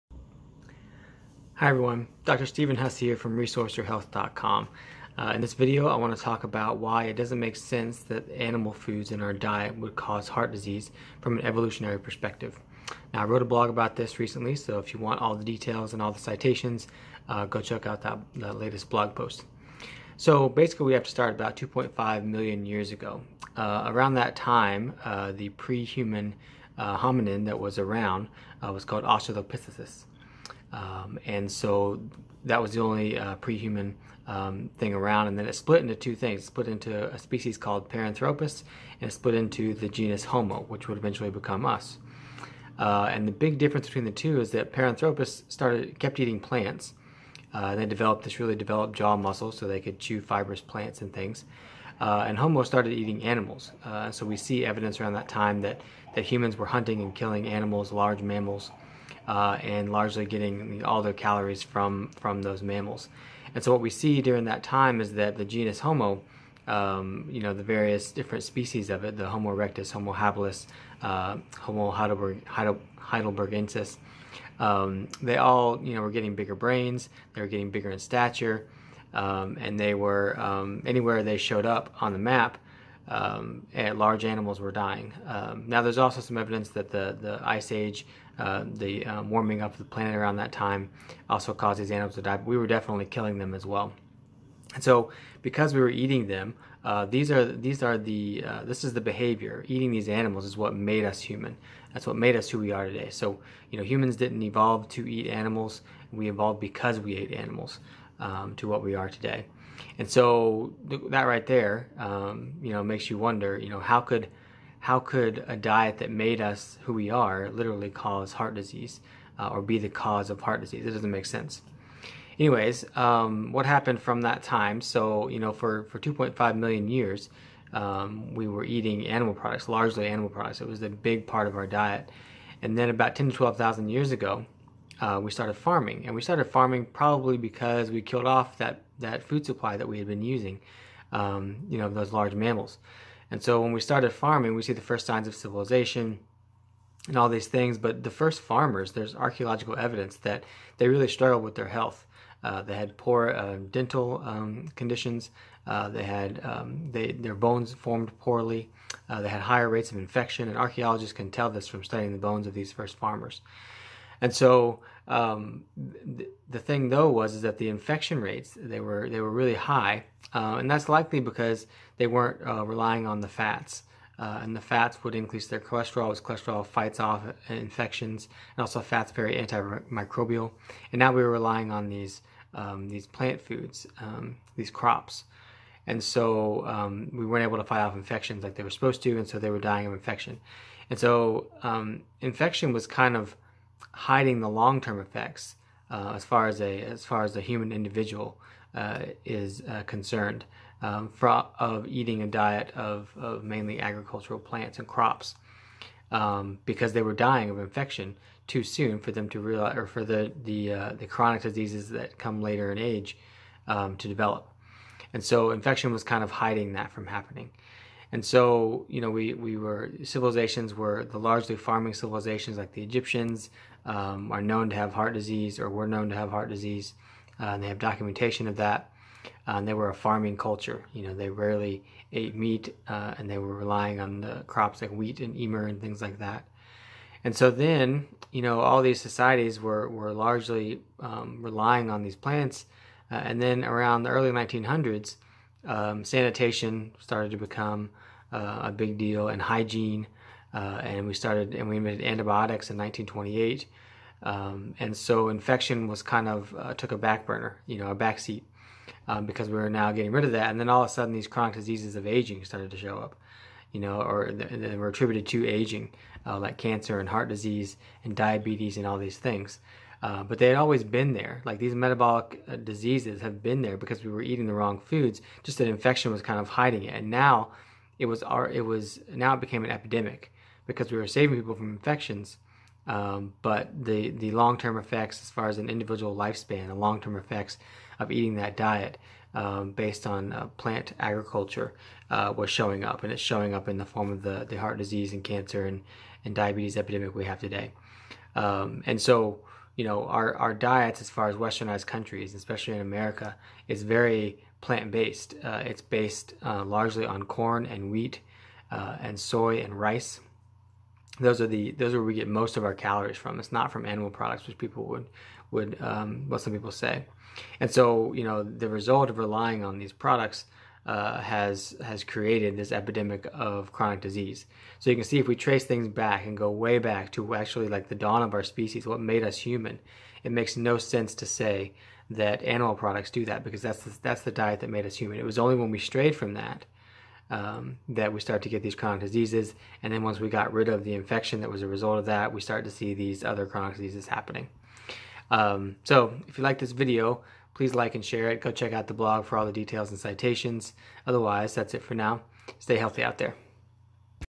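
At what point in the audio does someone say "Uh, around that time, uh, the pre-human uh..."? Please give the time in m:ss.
0:23.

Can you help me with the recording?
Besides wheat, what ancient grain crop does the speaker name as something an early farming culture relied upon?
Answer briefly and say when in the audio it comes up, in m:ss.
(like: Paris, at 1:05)
emmer, at 3:55.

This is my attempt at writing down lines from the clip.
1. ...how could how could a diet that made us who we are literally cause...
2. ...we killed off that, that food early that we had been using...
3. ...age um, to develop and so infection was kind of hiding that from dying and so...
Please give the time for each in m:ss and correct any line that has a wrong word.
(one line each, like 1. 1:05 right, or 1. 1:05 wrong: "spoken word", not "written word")
1. 1:53 right
2. 2:17 wrong: "supply", not "early"
3. 3:32 wrong: "happening", not "dying".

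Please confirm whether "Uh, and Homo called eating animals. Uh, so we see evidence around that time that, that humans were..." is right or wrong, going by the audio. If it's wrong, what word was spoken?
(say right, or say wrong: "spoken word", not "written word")
wrong: "started", not "called".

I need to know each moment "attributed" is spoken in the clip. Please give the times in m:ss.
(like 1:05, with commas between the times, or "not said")
4:24.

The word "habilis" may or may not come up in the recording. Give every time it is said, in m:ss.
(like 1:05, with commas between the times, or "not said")
1:10.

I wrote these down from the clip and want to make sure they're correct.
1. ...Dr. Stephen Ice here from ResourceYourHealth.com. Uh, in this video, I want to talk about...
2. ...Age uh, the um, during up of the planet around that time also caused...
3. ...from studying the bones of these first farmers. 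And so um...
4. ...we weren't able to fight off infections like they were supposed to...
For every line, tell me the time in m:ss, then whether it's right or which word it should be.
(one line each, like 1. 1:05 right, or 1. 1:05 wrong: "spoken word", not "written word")
1. 0:02 wrong: "Hess", not "Ice"
2. 1:27 wrong: "warming", not "during"
3. 2:41 right
4. 3:07 right.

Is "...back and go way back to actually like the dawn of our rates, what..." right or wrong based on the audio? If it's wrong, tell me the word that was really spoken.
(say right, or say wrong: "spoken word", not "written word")
wrong: "species", not "rates".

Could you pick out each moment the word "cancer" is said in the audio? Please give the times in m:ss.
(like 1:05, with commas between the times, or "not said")
4:26, 4:55.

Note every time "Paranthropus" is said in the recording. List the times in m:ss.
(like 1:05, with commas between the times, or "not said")
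0:37, 0:44.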